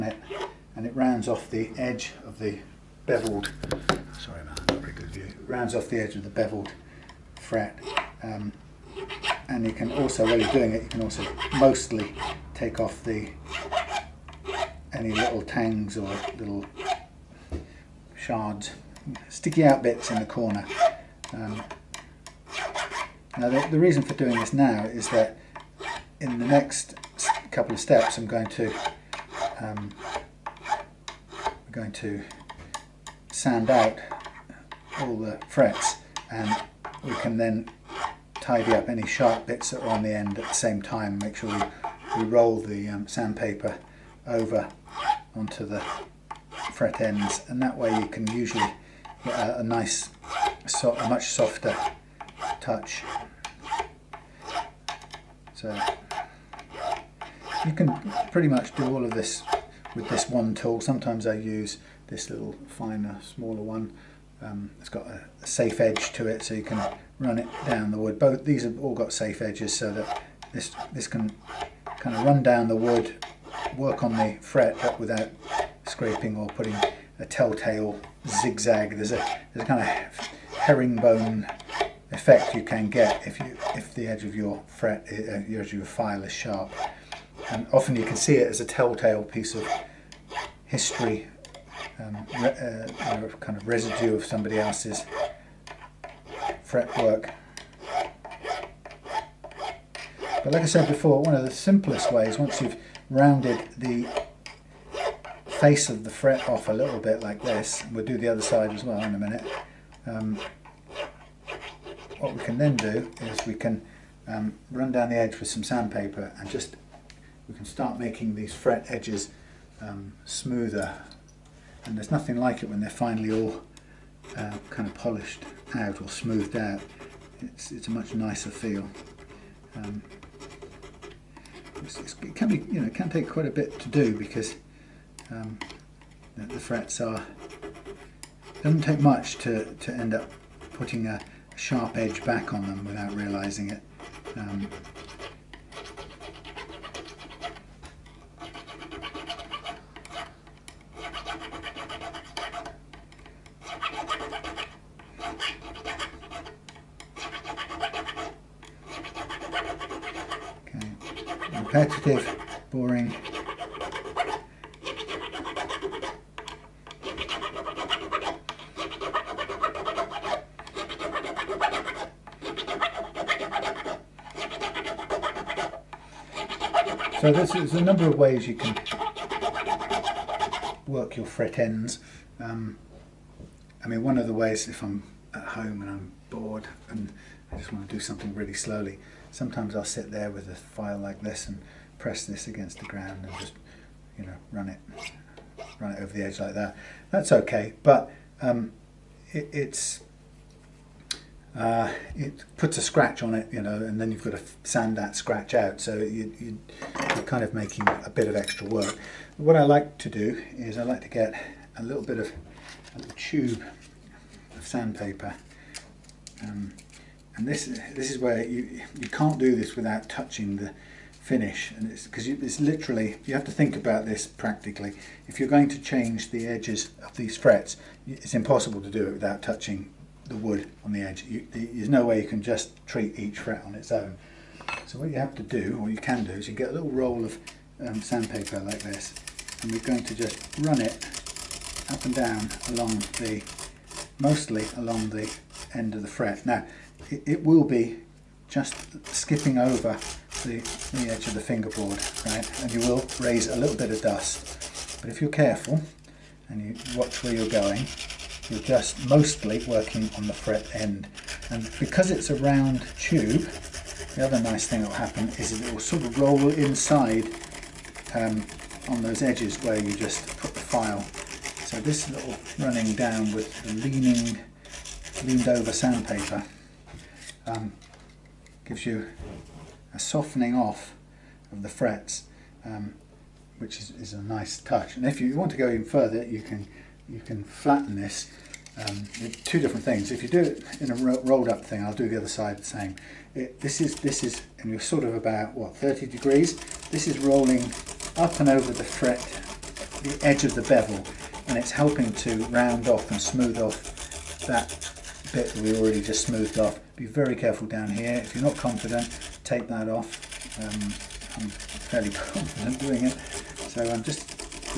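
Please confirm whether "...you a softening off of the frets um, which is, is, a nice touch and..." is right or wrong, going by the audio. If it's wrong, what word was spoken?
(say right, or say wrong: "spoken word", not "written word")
right.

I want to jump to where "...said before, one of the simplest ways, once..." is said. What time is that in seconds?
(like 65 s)
100 s.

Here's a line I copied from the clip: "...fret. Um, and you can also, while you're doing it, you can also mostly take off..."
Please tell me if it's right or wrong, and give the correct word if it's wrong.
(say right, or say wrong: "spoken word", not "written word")
right.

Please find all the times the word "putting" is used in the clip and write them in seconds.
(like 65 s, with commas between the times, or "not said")
76 s, 140 s.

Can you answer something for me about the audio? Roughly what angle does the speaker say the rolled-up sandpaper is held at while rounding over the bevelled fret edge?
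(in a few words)
30 degrees.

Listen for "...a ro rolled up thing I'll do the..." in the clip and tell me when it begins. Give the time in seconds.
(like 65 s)
290 s.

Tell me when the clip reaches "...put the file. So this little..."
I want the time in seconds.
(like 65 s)
270 s.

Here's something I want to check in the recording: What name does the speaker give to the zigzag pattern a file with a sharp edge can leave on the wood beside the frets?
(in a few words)
Herringbone.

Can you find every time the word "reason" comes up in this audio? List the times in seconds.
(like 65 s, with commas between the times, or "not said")
23 s.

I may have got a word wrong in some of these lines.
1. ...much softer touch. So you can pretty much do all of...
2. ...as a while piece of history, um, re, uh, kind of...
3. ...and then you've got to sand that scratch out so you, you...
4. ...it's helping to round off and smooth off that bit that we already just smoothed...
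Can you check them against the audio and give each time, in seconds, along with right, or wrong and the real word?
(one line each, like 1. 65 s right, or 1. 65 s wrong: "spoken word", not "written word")
1. 51 s right
2. 88 s wrong: "telltale", not "while"
3. 203 s right
4. 301 s right.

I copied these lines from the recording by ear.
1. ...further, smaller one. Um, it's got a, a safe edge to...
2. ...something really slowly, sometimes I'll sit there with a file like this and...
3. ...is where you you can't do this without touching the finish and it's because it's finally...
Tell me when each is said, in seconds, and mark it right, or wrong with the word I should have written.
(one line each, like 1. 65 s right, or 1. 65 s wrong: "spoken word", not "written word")
1. 62 s wrong: "finer", not "further"
2. 187 s right
3. 218 s wrong: "literally", not "finally".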